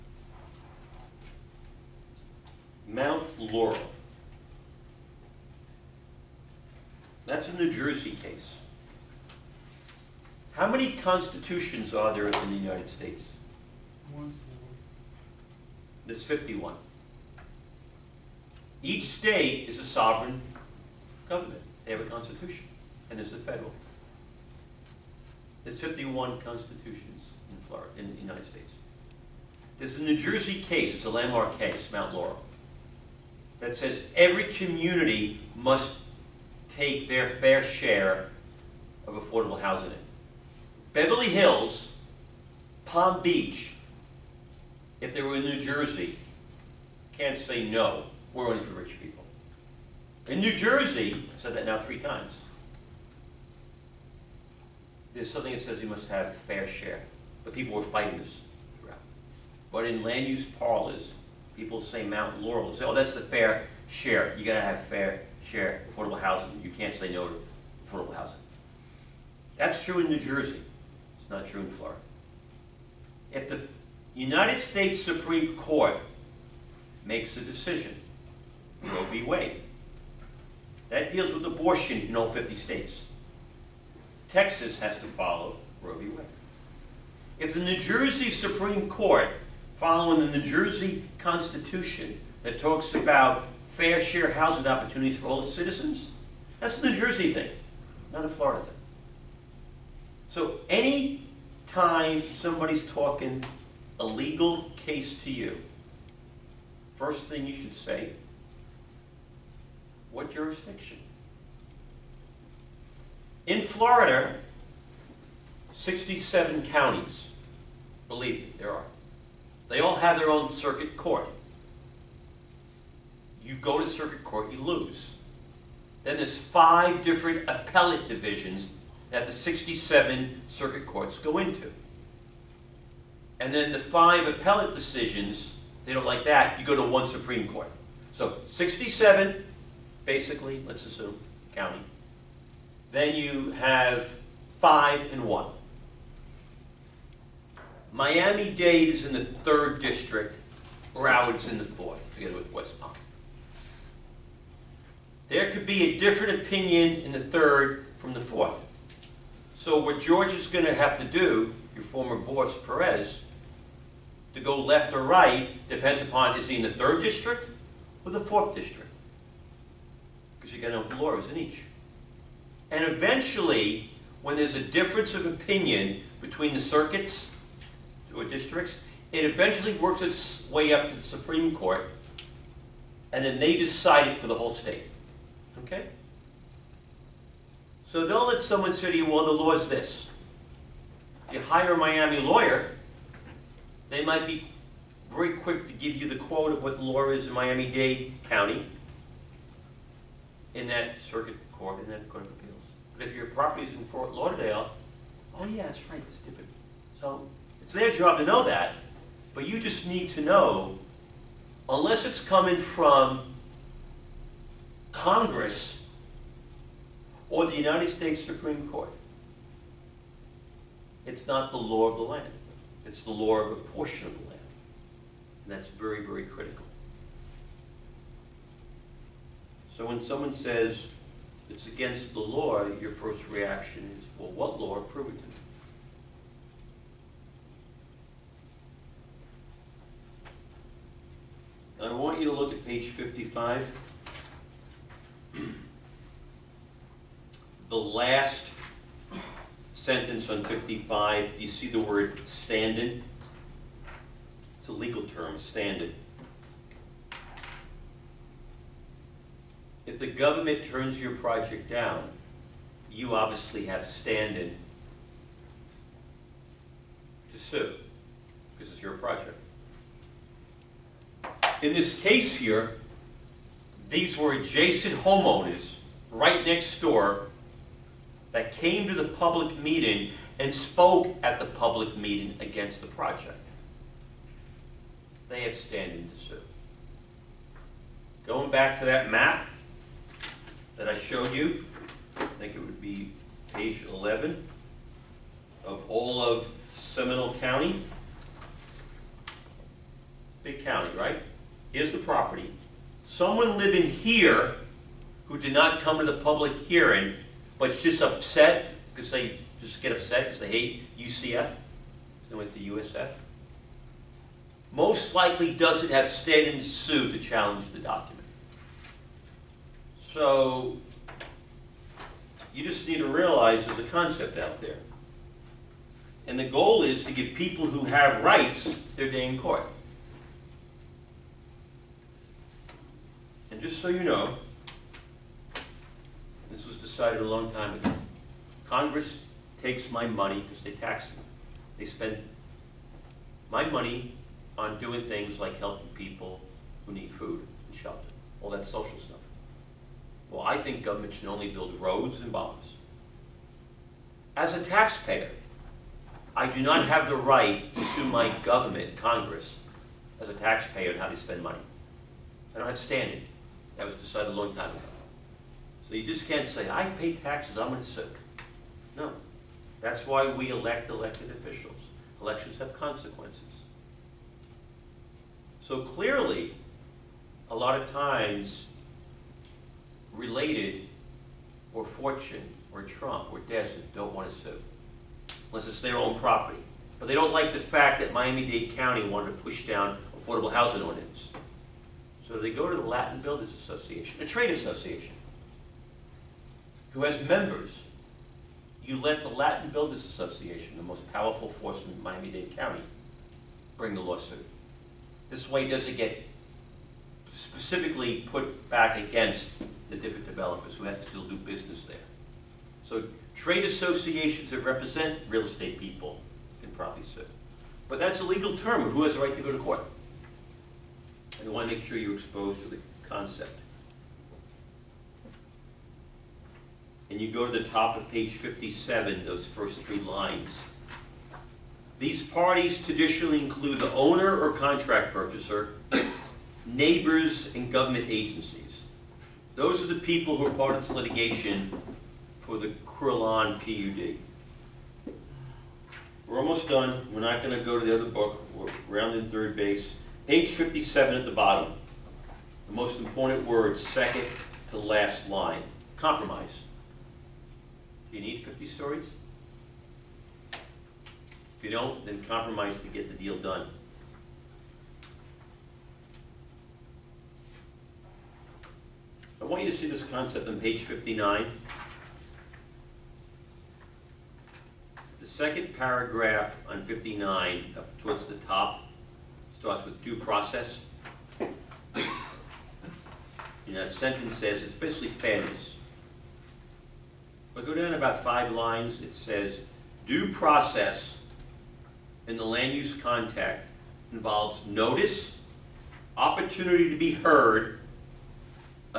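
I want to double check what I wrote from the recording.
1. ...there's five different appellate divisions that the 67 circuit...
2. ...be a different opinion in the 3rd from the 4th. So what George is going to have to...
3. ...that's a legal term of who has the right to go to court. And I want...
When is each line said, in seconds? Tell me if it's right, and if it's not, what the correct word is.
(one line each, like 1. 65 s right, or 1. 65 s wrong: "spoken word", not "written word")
1. 126 s right
2. 155 s right
3. 417 s right.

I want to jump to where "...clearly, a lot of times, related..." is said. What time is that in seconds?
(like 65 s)
375 s.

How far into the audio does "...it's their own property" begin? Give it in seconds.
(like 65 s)
385 s.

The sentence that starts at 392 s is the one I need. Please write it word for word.
So they go to the Latin Builders Association, a trade association, who has members.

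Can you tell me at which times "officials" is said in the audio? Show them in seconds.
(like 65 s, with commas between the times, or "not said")
371 s.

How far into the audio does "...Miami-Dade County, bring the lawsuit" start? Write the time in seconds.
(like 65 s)
402 s.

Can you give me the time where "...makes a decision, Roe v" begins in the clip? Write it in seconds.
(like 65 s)
77 s.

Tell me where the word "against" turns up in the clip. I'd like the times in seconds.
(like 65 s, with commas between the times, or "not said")
231 s, 282 s, 408 s.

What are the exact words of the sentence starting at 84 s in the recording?
Texas has to follow Roe v.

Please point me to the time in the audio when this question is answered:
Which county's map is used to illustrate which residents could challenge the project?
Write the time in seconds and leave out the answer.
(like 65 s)
296 s.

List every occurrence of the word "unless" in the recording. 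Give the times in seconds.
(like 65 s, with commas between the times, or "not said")
211 s, 385 s.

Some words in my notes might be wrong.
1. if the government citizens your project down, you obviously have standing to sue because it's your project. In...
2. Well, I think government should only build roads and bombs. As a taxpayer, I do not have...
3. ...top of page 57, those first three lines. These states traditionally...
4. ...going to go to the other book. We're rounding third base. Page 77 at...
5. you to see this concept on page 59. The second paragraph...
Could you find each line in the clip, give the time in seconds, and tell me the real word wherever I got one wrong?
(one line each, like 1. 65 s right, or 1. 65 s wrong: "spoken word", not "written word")
1. 259 s wrong: "turns", not "citizens"
2. 350 s right
3. 427 s wrong: "parties", not "states"
4. 447 s wrong: "57", not "77"
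5. 469 s right.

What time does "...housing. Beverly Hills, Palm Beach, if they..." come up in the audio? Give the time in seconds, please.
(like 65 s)
39 s.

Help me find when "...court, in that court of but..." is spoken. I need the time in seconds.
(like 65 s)
201 s.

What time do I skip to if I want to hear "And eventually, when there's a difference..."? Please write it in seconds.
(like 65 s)
172 s.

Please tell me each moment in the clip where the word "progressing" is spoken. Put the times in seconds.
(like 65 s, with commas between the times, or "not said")
not said.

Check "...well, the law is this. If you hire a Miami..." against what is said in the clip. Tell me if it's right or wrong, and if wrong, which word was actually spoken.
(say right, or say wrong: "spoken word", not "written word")
right.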